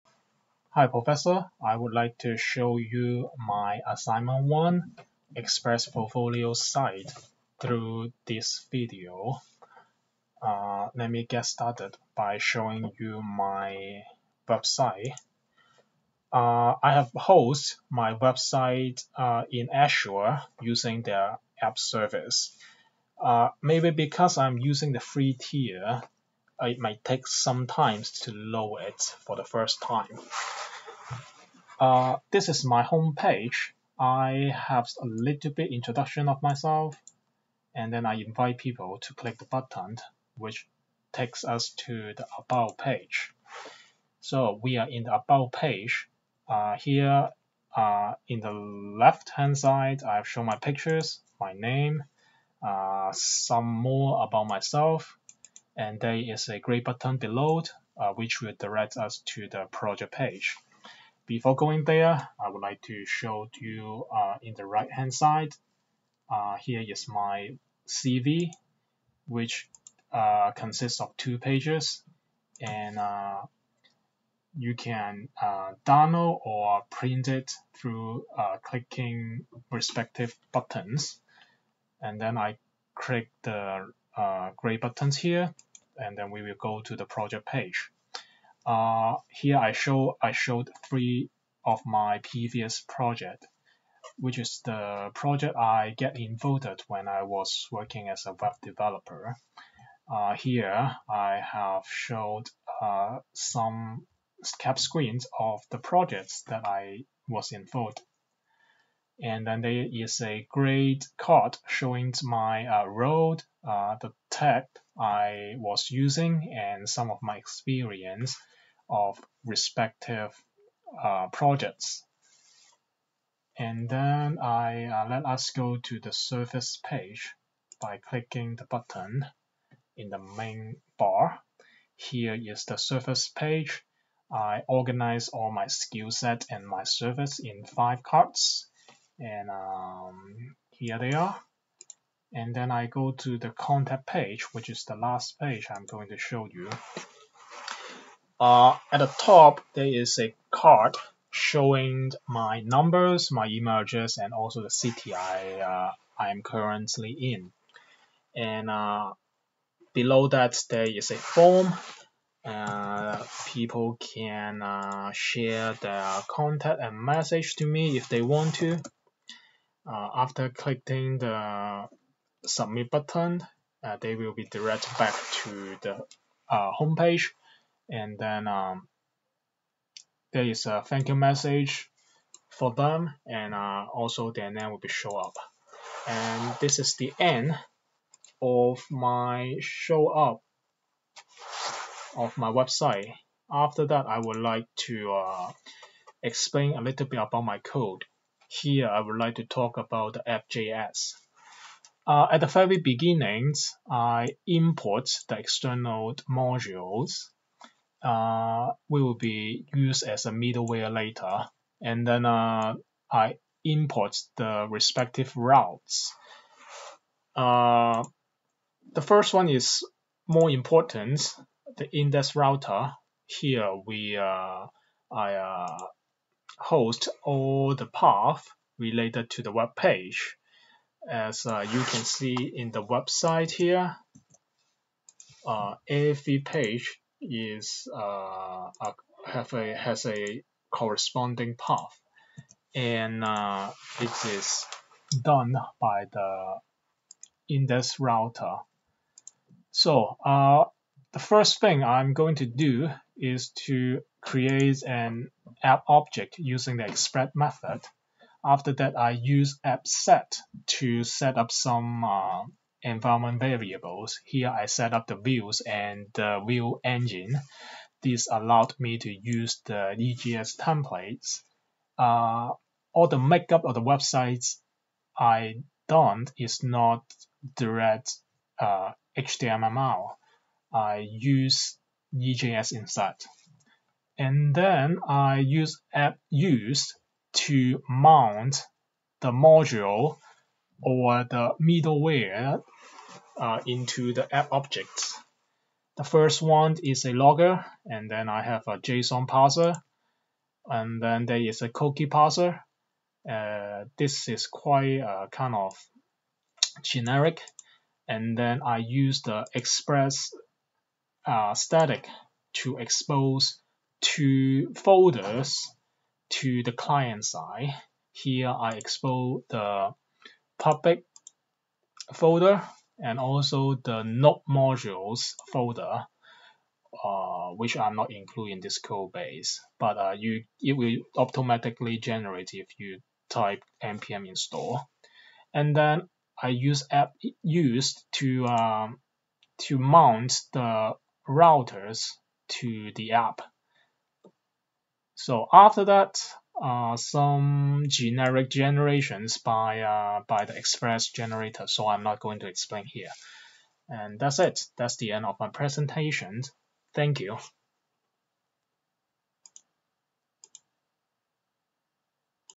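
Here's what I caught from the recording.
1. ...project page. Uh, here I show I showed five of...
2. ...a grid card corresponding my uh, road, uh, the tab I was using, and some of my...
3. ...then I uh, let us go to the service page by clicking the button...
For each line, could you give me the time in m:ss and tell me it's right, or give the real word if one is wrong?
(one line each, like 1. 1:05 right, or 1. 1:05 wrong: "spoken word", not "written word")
1. 1:27 wrong: "three", not "five"
2. 1:50 wrong: "showing", not "corresponding"
3. 2:03 right.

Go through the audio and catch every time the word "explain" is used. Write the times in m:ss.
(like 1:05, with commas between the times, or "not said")
3:16, 5:52.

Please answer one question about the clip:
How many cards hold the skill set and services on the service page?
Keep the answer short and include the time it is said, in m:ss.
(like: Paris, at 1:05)
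5, at 2:17.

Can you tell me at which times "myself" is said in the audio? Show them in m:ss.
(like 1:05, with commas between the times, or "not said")
0:36, 0:54.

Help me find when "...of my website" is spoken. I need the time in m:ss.
3:12.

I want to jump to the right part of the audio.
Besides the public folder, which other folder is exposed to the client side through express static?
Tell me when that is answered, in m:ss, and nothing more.
5:24.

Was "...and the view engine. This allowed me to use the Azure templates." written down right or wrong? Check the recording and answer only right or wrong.
wrong.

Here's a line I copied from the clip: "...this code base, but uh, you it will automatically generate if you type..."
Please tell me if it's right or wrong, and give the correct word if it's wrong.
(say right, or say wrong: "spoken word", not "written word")
right.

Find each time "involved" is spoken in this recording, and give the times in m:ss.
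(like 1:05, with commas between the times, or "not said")
1:36, 1:47.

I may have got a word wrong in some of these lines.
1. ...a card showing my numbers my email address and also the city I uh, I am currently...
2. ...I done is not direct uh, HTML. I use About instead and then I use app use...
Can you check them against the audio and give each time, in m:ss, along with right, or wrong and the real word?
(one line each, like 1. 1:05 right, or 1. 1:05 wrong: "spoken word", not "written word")
1. 2:30 right
2. 4:35 wrong: "EJS", not "About".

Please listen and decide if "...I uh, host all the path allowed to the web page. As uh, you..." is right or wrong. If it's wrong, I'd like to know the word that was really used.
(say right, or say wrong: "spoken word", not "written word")
wrong: "related", not "allowed".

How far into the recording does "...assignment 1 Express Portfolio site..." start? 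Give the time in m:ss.
0:03.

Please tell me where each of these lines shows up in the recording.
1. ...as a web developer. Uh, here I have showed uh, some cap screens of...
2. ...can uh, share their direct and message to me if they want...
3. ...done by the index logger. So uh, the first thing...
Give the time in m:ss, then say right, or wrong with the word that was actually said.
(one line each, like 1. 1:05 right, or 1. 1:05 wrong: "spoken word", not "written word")
1. 1:38 right
2. 2:43 wrong: "contact", not "direct"
3. 4:05 wrong: "router", not "logger".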